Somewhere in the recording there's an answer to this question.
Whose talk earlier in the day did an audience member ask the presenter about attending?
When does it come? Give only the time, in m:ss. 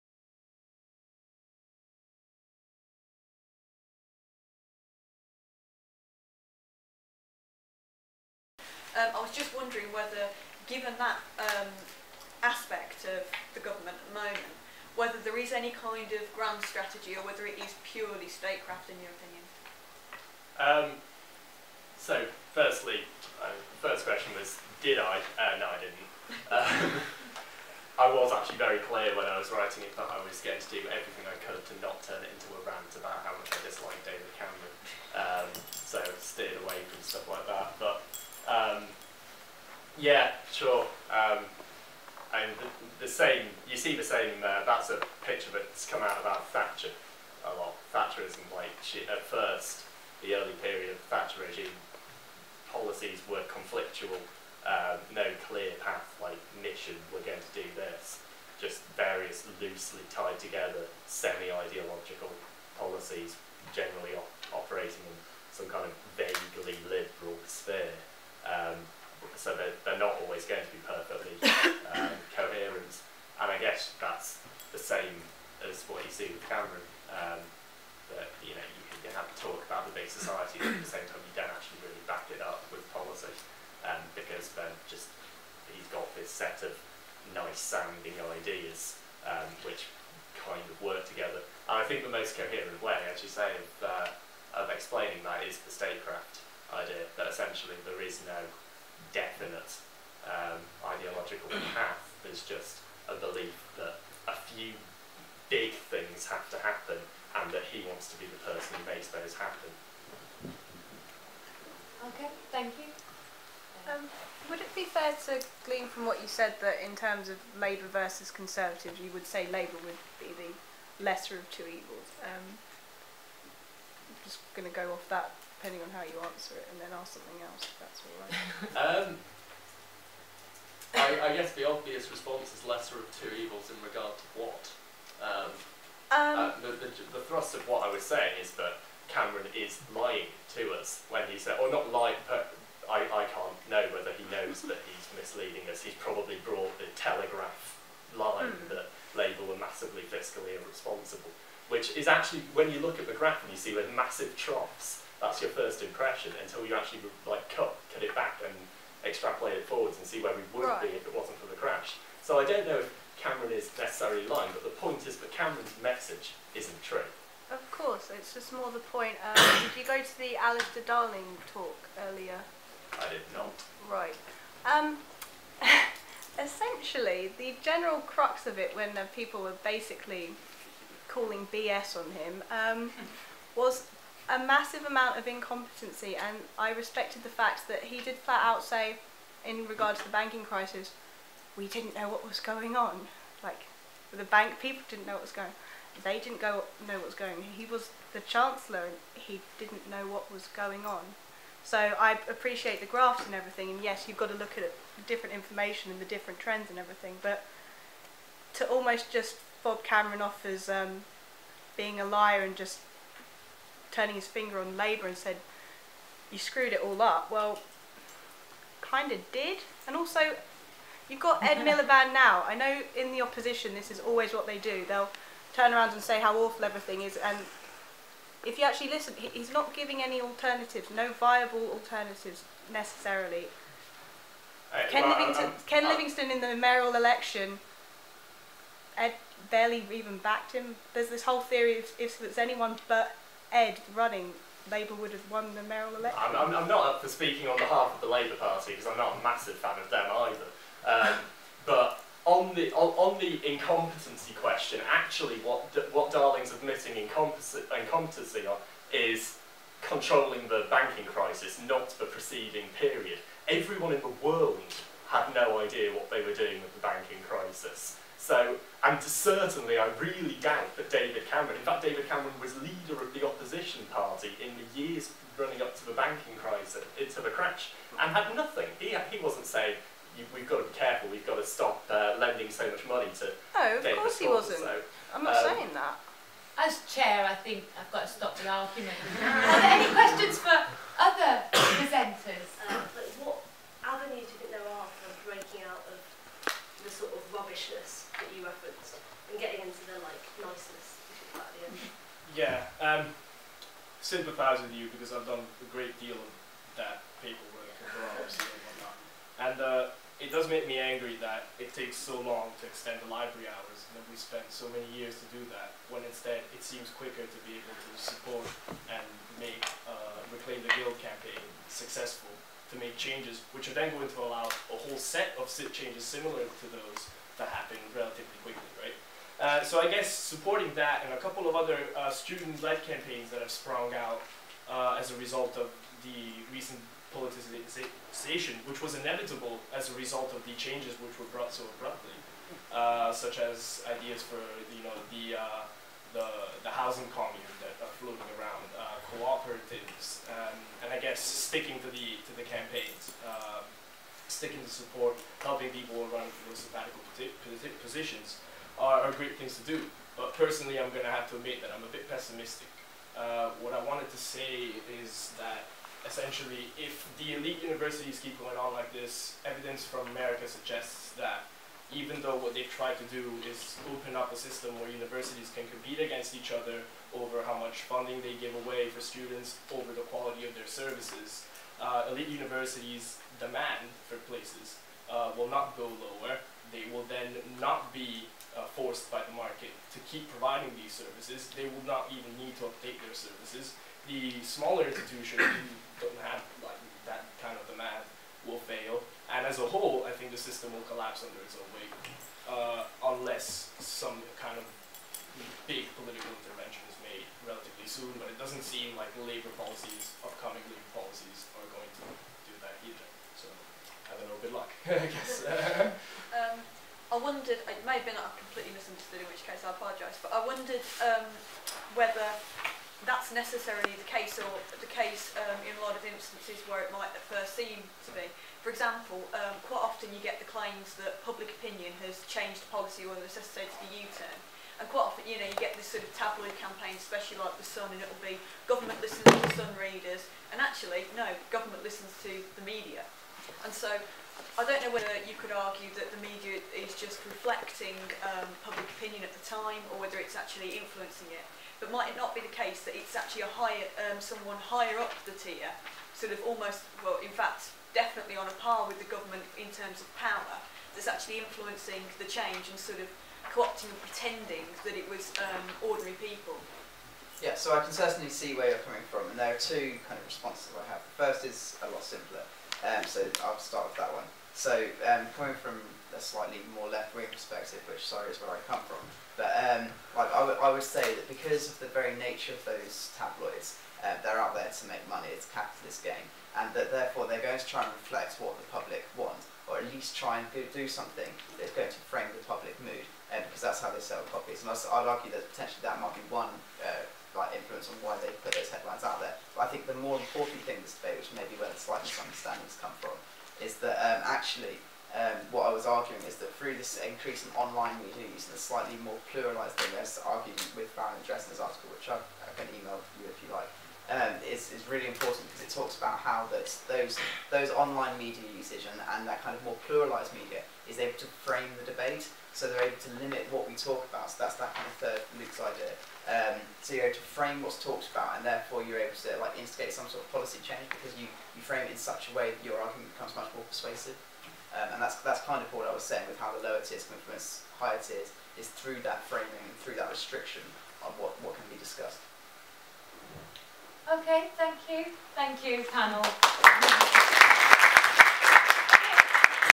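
2:50.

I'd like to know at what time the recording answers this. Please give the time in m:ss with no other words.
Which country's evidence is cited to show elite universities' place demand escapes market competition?
6:10.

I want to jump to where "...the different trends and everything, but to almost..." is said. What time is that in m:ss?
3:26.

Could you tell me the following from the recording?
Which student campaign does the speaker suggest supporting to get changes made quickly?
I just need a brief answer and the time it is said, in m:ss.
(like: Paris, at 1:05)
Reclaim the Guild, at 5:20.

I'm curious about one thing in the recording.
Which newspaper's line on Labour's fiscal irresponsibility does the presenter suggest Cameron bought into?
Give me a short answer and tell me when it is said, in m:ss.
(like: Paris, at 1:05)
The Telegraph, at 2:26.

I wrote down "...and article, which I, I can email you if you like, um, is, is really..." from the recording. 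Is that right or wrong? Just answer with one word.
right.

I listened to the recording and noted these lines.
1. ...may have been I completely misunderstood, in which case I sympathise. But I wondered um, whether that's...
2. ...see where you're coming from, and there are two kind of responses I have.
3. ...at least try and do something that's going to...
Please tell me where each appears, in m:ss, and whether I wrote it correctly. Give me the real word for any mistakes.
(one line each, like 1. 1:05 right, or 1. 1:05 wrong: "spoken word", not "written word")
1. 6:57 wrong: "apologise", not "sympathise"
2. 7:48 right
3. 8:09 right.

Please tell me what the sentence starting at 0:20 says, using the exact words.
Um, so, firstly, uh, the first question was, did I?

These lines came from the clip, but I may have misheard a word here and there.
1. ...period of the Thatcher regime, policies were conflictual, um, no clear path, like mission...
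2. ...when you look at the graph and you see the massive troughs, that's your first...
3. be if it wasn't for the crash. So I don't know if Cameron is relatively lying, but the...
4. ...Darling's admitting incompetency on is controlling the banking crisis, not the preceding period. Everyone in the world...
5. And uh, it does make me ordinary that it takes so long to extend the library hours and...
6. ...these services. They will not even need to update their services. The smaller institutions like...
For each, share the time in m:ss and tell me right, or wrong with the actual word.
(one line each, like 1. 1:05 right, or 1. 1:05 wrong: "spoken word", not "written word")
1. 0:50 right
2. 2:32 right
3. 2:40 wrong: "necessarily", not "relatively"
4. 4:16 right
5. 5:09 wrong: "angry", not "ordinary"
6. 6:30 right.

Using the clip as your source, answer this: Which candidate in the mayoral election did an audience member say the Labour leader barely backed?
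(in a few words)
Ken Livingstone.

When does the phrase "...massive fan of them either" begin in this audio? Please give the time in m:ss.
4:09.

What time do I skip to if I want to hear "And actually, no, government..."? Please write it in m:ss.
7:20.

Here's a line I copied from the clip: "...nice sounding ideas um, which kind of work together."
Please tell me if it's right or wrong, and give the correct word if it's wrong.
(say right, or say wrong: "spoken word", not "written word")
right.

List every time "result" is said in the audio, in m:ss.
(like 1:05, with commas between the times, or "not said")
5:35, 5:39.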